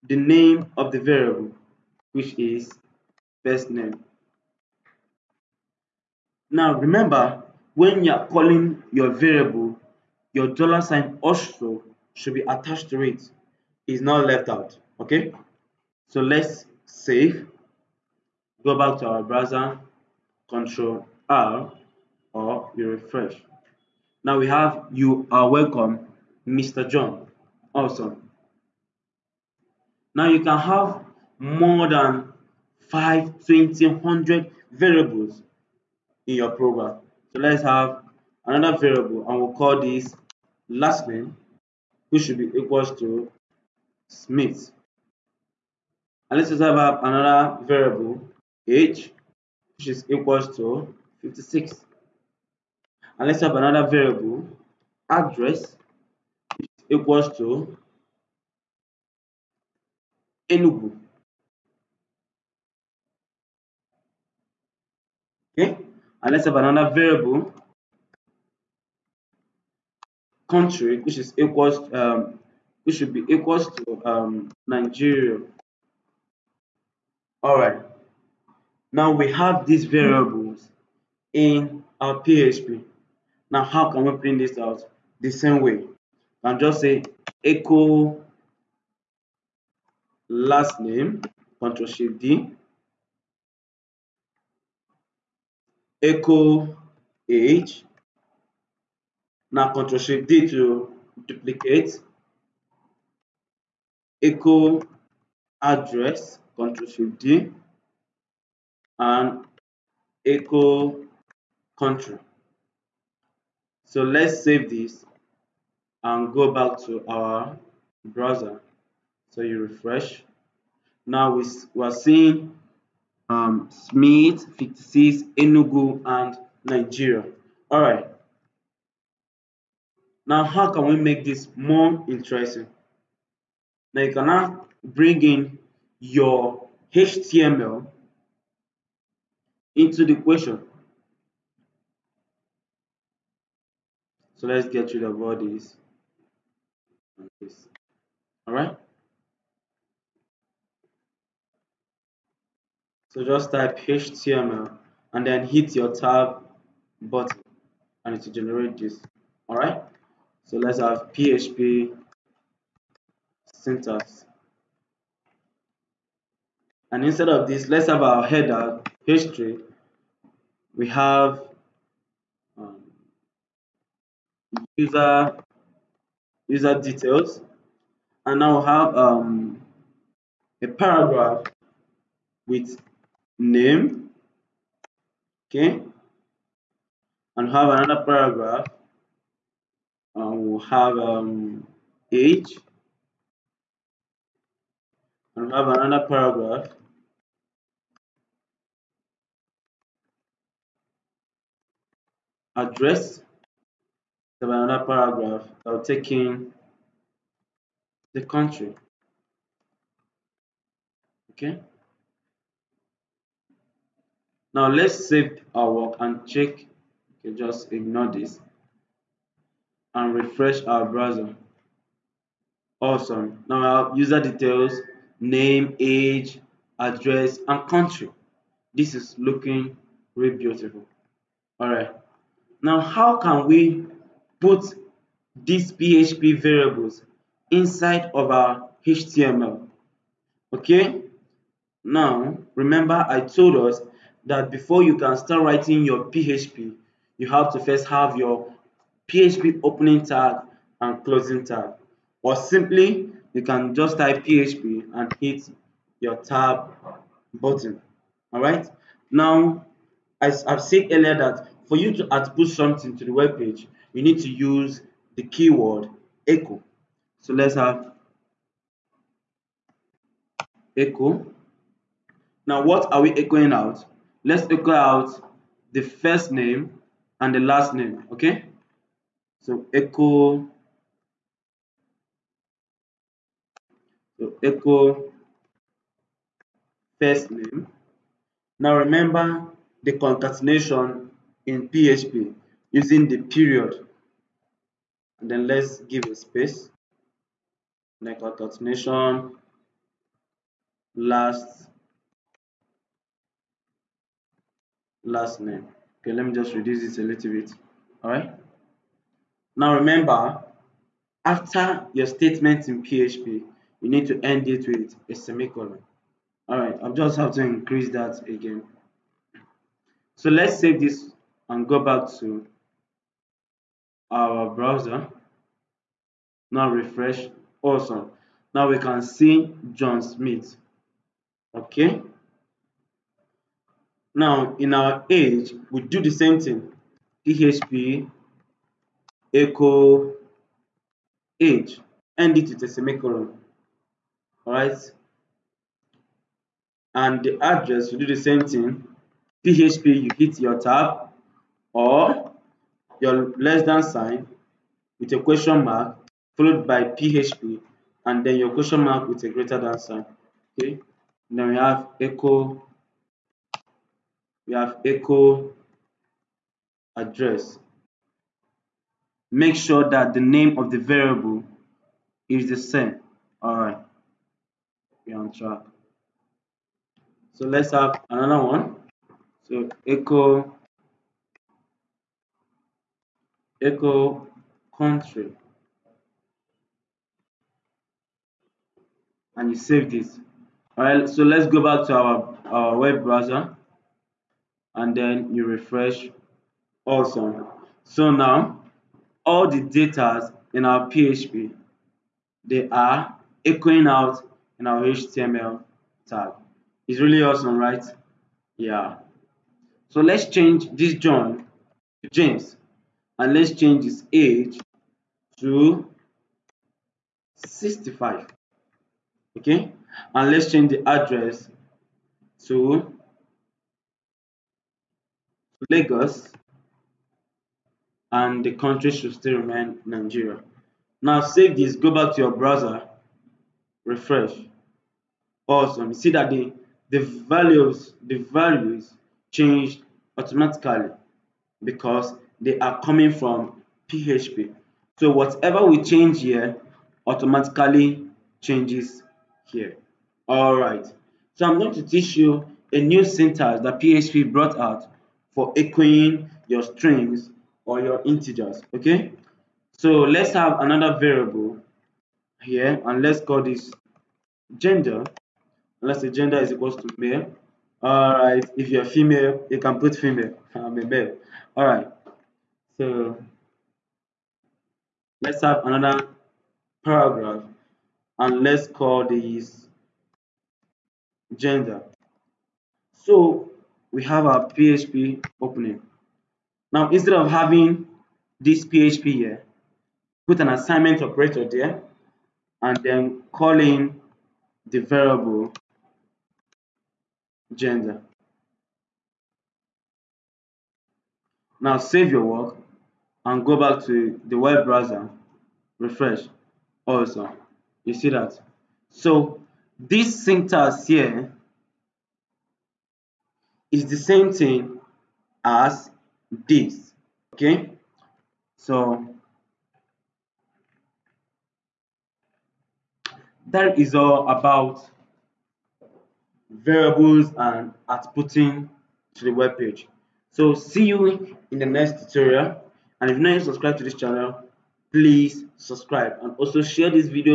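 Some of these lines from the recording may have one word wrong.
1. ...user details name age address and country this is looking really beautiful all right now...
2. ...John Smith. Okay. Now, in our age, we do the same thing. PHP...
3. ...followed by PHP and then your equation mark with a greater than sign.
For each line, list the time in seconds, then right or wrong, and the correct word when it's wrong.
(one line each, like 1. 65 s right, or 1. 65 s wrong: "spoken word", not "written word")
1. 223 s right
2. 329 s right
3. 356 s wrong: "question", not "equation".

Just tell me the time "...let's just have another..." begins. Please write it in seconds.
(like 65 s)
46 s.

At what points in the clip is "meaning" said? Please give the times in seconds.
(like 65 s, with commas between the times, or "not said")
not said.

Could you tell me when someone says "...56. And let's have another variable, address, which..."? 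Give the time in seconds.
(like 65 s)
51 s.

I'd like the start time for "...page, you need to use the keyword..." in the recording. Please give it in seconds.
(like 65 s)
263 s.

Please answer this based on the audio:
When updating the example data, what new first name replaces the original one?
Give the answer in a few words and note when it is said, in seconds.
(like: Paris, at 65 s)
James, at 412 s.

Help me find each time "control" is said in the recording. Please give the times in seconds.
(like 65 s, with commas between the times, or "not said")
20 s, 91 s, 99 s, 106 s.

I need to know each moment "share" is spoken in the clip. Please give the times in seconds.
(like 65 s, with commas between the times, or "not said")
536 s.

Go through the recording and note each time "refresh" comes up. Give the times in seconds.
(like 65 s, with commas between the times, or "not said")
22 s, 119 s, 220 s, 326 s, 395 s, 433 s, 505 s.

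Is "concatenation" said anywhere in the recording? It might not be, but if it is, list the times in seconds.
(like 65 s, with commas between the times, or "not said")
289 s, 298 s.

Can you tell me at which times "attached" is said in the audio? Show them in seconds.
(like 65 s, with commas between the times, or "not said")
12 s.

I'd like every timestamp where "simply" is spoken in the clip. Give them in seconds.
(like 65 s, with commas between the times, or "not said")
252 s.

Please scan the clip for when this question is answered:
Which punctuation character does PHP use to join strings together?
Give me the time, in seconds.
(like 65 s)
293 s.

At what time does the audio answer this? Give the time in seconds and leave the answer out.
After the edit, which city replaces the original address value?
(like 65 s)
425 s.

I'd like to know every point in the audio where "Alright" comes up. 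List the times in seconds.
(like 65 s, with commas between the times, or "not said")
159 s, 344 s, 450 s.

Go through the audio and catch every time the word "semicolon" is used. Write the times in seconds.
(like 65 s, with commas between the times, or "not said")
315 s, 342 s.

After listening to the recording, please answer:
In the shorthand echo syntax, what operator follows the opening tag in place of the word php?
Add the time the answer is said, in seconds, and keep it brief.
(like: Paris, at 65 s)
Assignment operator, at 490 s.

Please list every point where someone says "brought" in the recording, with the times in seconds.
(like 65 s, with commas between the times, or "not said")
454 s.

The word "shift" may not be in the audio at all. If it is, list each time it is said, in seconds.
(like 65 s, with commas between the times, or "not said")
91 s, 99 s, 106 s.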